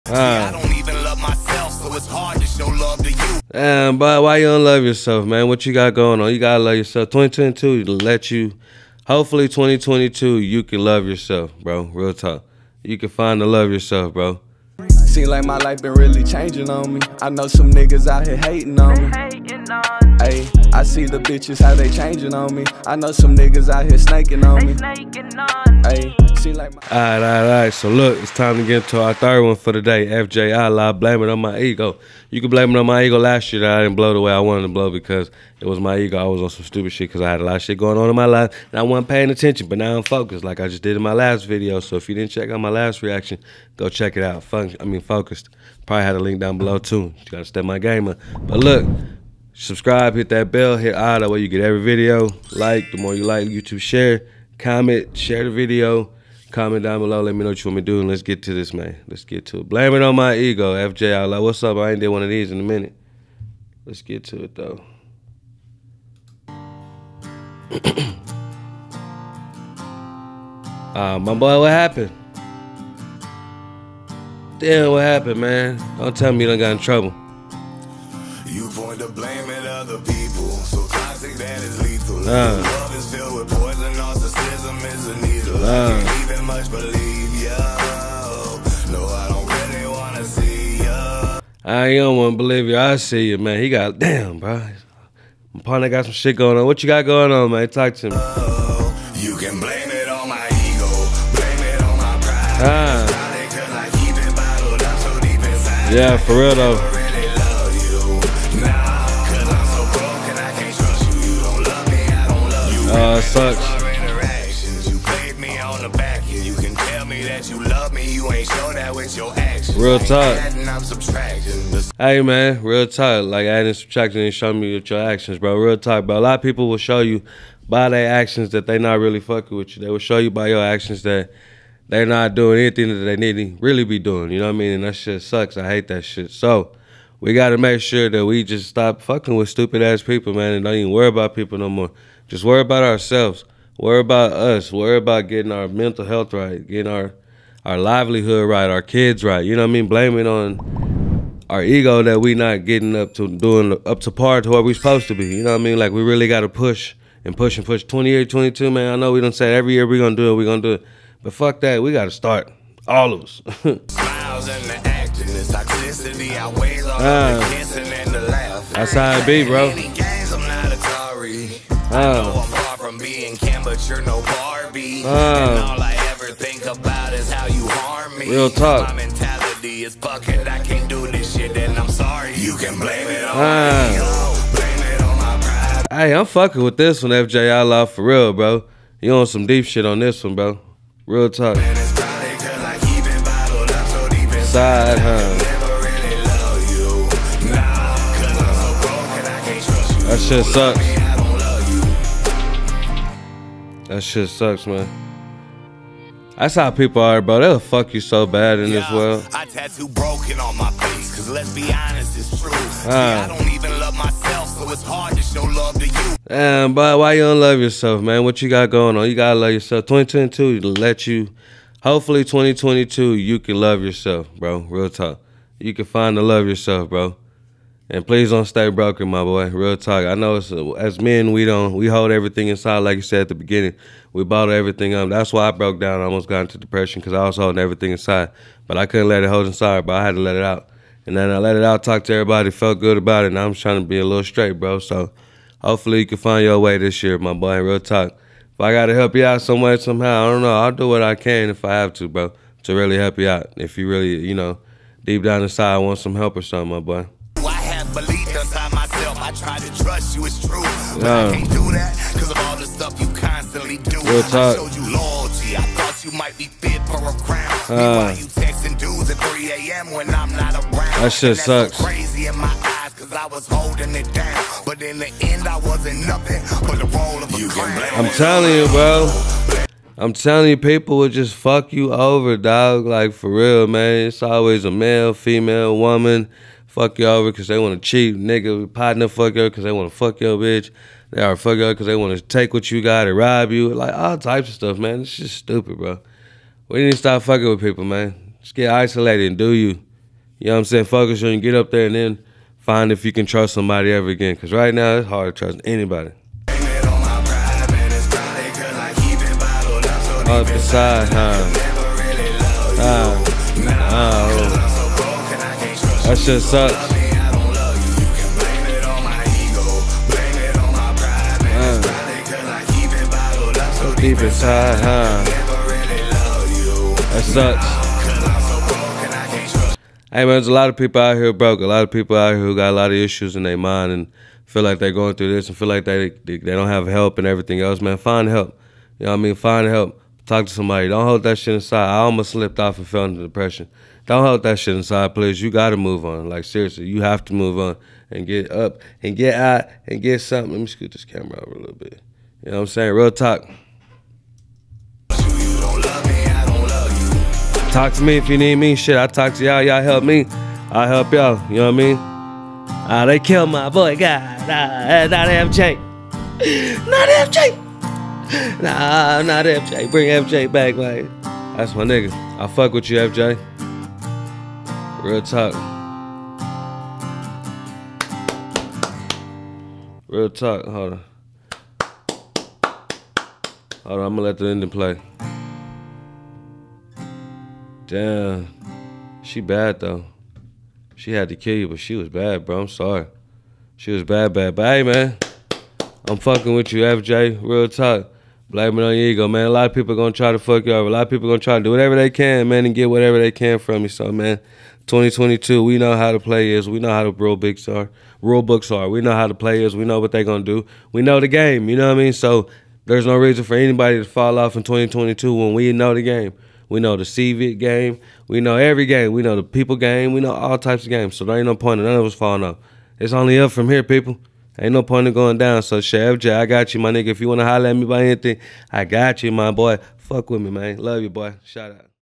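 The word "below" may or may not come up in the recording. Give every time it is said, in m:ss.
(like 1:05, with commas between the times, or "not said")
0:46, 0:56.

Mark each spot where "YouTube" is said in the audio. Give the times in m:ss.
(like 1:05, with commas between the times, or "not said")
0:53.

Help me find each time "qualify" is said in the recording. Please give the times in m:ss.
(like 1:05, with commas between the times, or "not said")
not said.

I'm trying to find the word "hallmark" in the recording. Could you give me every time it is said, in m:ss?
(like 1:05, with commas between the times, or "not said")
not said.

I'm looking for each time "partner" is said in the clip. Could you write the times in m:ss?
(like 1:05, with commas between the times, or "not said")
1:35, 4:48.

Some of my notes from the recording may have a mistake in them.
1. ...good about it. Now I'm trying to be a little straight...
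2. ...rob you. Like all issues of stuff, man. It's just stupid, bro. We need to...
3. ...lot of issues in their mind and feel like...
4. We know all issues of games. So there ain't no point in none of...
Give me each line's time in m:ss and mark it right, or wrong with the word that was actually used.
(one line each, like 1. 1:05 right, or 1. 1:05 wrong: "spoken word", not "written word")
1. 4:02 right
2. 4:53 wrong: "types", not "issues"
3. 5:32 right
4. 7:00 wrong: "types", not "issues".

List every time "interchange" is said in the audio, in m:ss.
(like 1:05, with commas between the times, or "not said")
not said.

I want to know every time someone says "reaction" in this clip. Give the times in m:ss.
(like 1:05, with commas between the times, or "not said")
0:43.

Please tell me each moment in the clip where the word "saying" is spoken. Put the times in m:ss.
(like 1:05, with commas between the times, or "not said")
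5:00, 5:52.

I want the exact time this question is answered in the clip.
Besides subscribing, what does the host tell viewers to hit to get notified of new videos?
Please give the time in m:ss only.
0:50.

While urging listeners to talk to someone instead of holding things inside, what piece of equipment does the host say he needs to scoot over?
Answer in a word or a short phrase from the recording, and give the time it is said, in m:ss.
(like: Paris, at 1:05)
camera, at 5:51.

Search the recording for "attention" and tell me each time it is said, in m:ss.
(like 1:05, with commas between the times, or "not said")
0:39.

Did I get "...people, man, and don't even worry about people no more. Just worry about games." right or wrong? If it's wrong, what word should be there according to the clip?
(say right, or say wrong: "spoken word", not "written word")
wrong: "ourselves", not "games".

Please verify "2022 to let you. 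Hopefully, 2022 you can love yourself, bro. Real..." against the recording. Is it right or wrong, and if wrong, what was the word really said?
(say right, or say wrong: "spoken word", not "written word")
right.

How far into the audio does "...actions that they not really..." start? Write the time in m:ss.
2:08.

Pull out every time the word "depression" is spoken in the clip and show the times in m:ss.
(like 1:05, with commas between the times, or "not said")
3:56, 5:43.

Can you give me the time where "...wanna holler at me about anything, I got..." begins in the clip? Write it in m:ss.
7:07.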